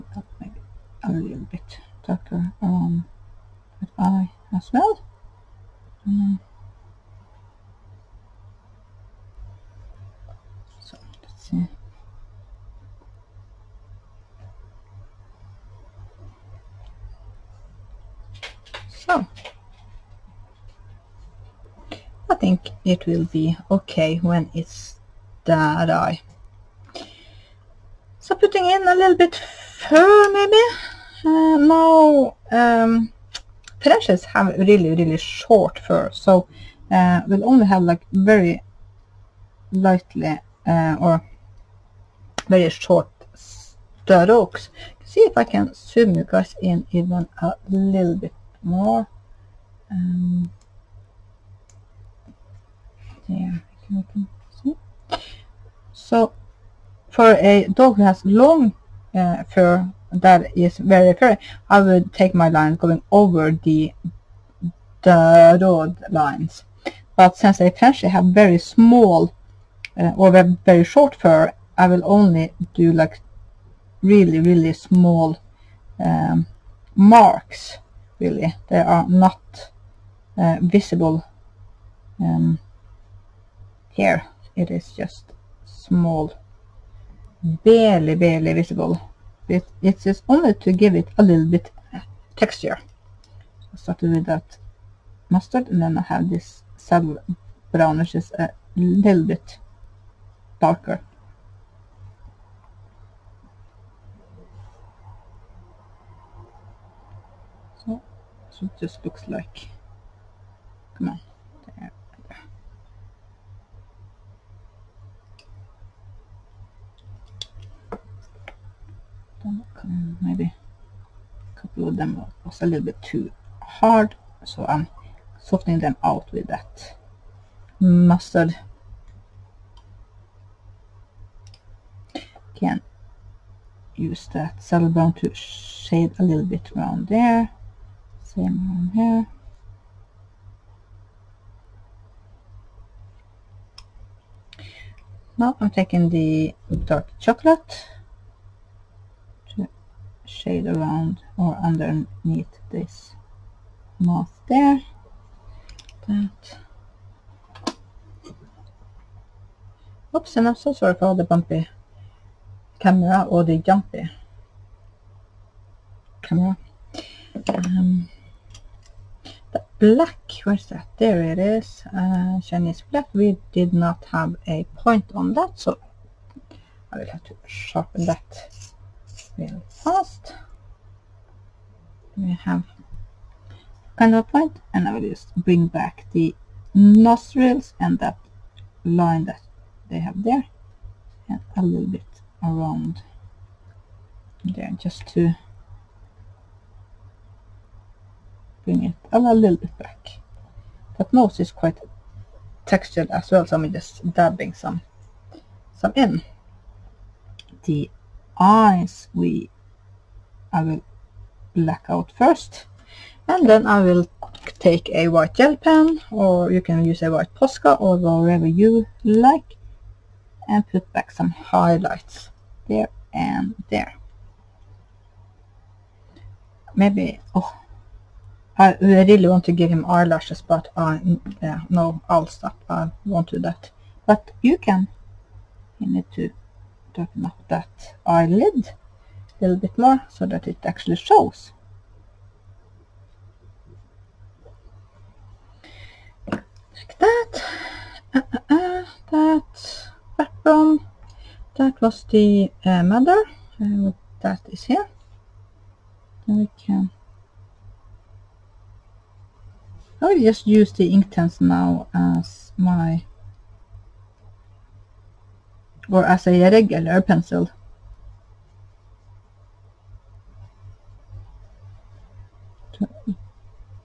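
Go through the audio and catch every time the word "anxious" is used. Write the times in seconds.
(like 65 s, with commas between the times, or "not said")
not said.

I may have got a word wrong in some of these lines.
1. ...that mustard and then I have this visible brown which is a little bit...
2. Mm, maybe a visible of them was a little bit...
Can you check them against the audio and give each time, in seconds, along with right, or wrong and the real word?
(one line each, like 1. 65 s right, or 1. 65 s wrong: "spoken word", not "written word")
1. 94 s wrong: "saddle", not "visible"
2. 119 s wrong: "couple", not "visible".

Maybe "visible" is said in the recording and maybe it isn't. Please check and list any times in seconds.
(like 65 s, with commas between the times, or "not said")
80 s, 88 s.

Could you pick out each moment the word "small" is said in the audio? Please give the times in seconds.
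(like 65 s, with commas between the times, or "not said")
68 s, 74 s, 85 s.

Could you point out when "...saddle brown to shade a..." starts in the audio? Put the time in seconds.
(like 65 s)
134 s.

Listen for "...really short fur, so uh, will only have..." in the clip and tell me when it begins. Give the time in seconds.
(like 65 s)
34 s.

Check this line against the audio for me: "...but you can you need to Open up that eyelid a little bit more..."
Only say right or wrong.
right.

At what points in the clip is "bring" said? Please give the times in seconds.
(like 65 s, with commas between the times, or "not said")
185 s, 198 s.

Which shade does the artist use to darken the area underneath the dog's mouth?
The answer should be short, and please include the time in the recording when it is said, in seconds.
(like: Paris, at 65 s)
Dark chocolate, at 146 s.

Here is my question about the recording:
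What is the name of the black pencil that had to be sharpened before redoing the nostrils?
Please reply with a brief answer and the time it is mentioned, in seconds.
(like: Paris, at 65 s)
Chinese black, at 172 s.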